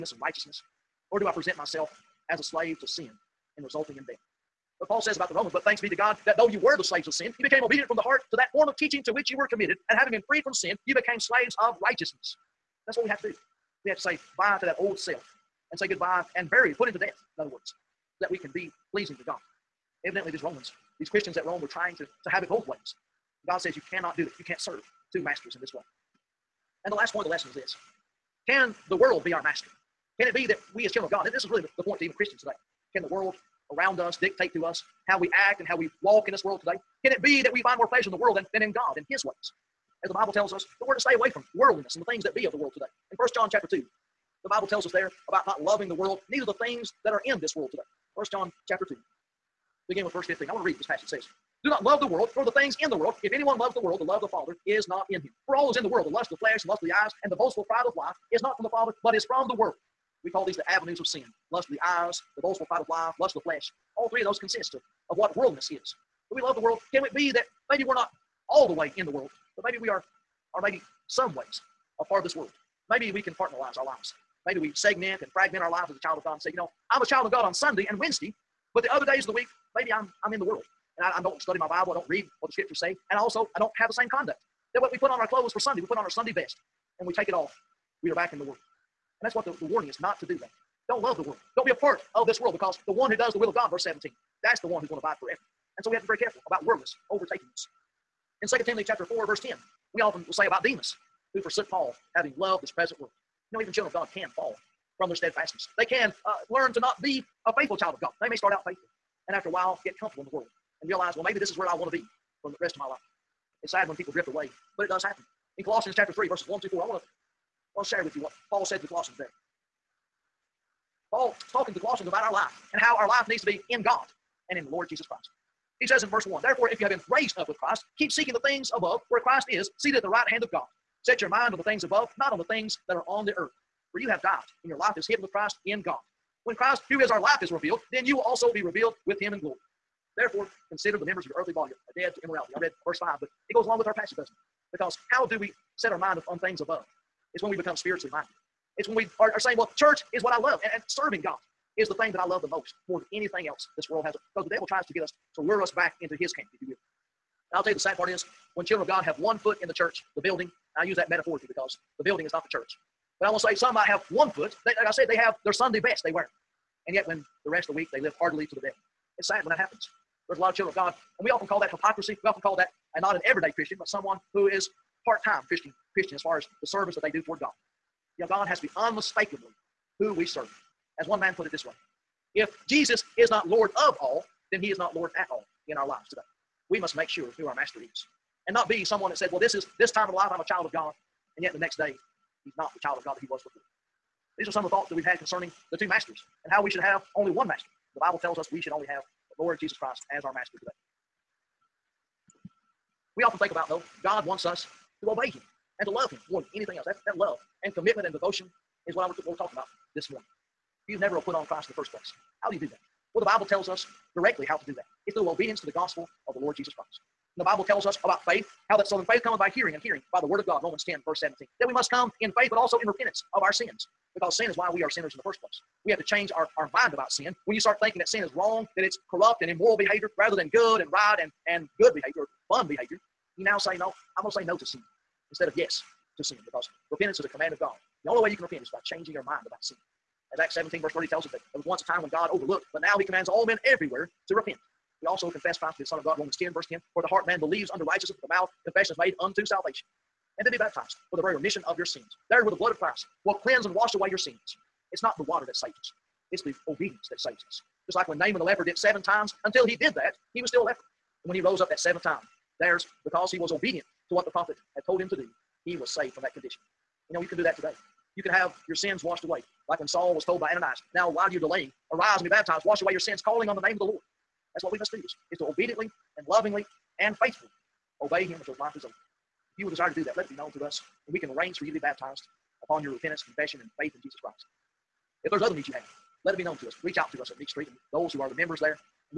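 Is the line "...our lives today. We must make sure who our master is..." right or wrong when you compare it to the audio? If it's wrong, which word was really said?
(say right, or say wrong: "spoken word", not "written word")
right.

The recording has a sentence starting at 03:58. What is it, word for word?
The only way you can repent is by changing your mind about sin.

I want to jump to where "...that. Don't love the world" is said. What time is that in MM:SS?
01:30.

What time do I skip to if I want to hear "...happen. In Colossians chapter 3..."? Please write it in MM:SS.
01:55.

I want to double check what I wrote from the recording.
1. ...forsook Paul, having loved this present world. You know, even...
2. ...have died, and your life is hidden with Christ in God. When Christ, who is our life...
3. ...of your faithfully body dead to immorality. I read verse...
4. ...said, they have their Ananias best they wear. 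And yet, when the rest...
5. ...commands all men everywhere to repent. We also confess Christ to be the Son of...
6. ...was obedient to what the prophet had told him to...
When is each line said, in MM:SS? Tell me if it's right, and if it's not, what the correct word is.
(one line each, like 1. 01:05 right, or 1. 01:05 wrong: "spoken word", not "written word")
1. 01:41 right
2. 02:14 right
3. 02:21 wrong: "earthly", not "faithfully"
4. 02:44 wrong: "Sunday", not "Ananias"
5. 04:03 right
6. 04:23 right.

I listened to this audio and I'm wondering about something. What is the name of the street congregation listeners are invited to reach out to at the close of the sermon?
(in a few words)
Meeks Street.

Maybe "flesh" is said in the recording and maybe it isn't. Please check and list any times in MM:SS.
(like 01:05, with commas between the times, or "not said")
00:56, 01:03.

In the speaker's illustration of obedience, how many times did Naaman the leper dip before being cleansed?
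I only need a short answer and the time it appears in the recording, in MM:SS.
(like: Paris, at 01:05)
7, at 04:18.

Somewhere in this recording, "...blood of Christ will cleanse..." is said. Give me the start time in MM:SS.
04:12.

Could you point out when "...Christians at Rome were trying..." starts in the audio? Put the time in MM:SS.
00:21.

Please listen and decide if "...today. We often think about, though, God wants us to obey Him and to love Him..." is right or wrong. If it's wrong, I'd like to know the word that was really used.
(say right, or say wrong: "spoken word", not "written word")
right.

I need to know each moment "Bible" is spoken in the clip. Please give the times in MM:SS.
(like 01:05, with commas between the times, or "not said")
00:40, 00:44, 01:21, 03:17, 03:33, 03:37.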